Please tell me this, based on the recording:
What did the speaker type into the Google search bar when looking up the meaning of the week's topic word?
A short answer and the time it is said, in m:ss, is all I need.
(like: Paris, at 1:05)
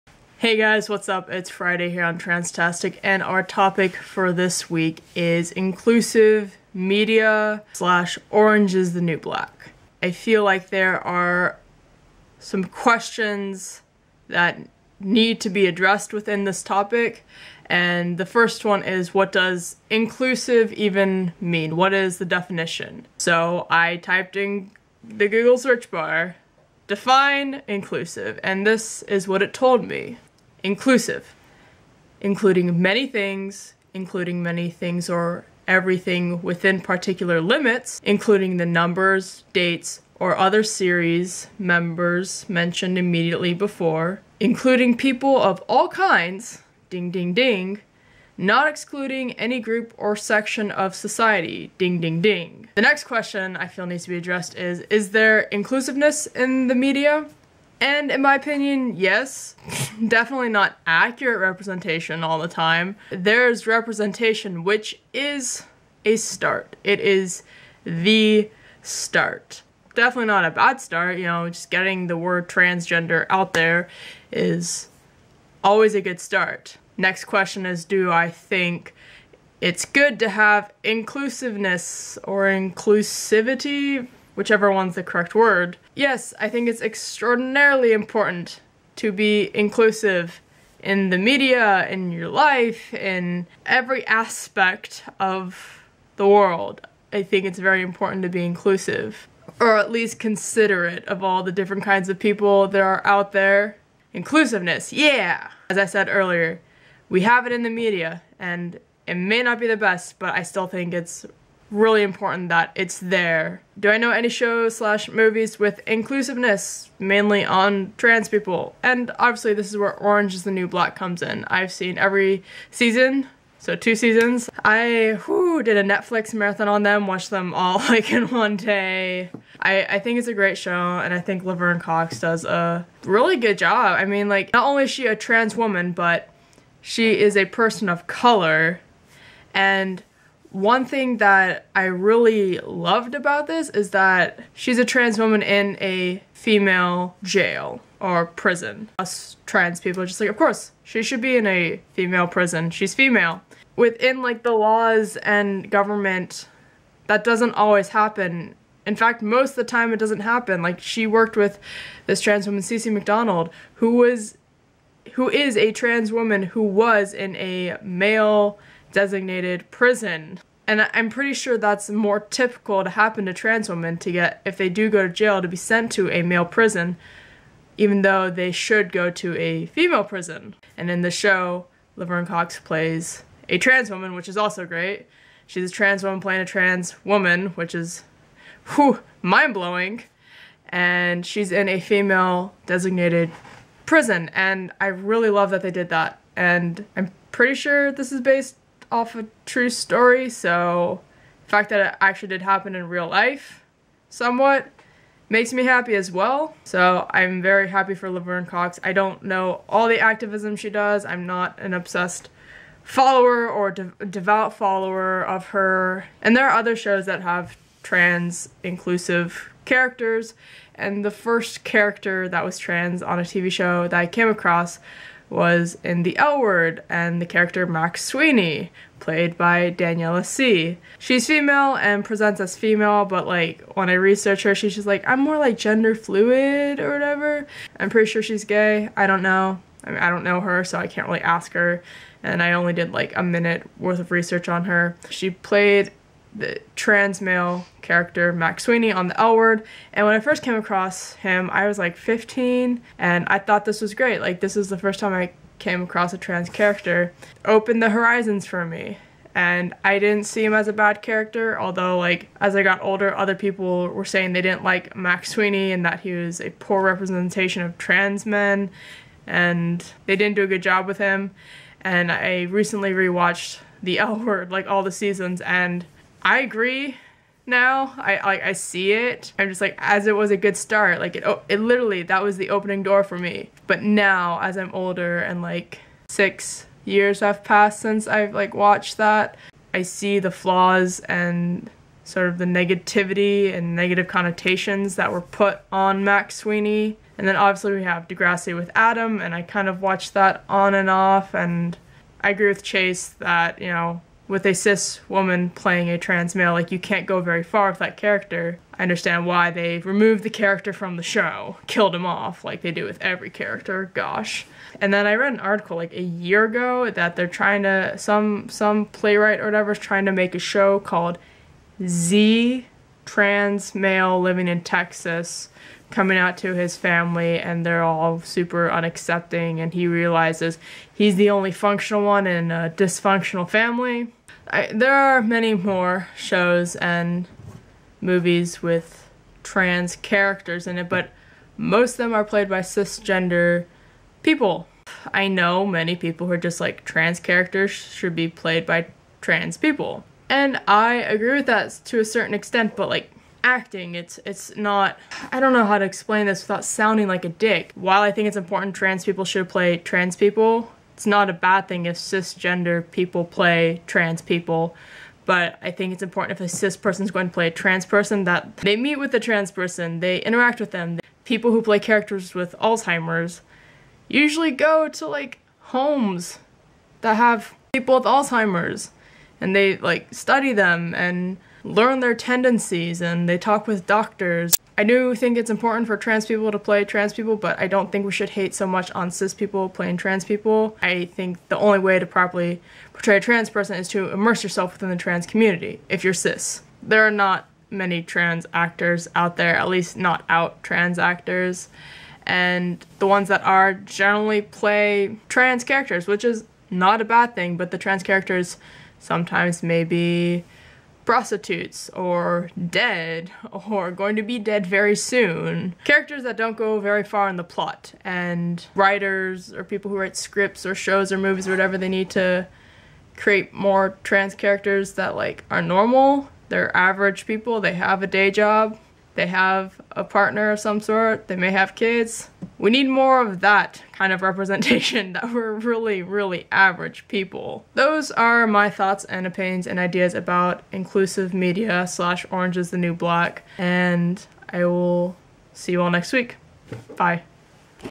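define inclusive, at 0:26.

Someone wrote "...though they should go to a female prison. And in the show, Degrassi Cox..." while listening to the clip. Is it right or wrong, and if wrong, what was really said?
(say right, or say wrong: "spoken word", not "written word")
wrong: "Laverne", not "Degrassi".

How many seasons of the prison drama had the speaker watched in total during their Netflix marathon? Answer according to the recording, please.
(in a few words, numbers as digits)
2.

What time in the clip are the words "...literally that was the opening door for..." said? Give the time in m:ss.
4:41.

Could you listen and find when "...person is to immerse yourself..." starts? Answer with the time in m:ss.
6:33.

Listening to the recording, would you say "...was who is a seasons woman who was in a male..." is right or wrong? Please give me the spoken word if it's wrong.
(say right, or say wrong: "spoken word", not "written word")
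wrong: "trans", not "seasons".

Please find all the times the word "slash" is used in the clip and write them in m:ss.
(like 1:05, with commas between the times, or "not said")
0:07, 1:54, 7:21.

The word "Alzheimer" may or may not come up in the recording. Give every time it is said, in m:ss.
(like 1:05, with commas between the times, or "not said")
6:12, 6:18.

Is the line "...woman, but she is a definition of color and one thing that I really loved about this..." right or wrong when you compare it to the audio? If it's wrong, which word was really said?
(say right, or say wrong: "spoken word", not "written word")
wrong: "person", not "definition".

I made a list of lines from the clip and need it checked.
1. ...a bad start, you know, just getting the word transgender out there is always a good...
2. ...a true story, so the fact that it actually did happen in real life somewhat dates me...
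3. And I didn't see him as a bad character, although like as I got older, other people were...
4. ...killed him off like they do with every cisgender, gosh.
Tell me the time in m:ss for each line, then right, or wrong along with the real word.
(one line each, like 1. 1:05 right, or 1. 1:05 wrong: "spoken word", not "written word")
1. 1:10 right
2. 3:19 wrong: "makes", not "dates"
3. 4:19 right
4. 5:11 wrong: "character", not "cisgender".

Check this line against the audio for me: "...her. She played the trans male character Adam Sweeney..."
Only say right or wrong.
wrong.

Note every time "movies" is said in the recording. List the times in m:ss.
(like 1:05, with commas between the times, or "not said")
1:55, 5:38, 7:01.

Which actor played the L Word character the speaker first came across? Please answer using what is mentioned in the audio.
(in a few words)
Daniela Sea.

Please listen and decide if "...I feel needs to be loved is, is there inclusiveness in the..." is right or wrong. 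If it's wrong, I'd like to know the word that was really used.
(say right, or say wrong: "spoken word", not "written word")
wrong: "addressed", not "loved".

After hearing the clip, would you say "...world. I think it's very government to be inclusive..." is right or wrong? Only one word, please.
wrong.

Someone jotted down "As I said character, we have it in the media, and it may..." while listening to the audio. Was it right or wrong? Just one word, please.
wrong.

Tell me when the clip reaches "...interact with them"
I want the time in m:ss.
6:10.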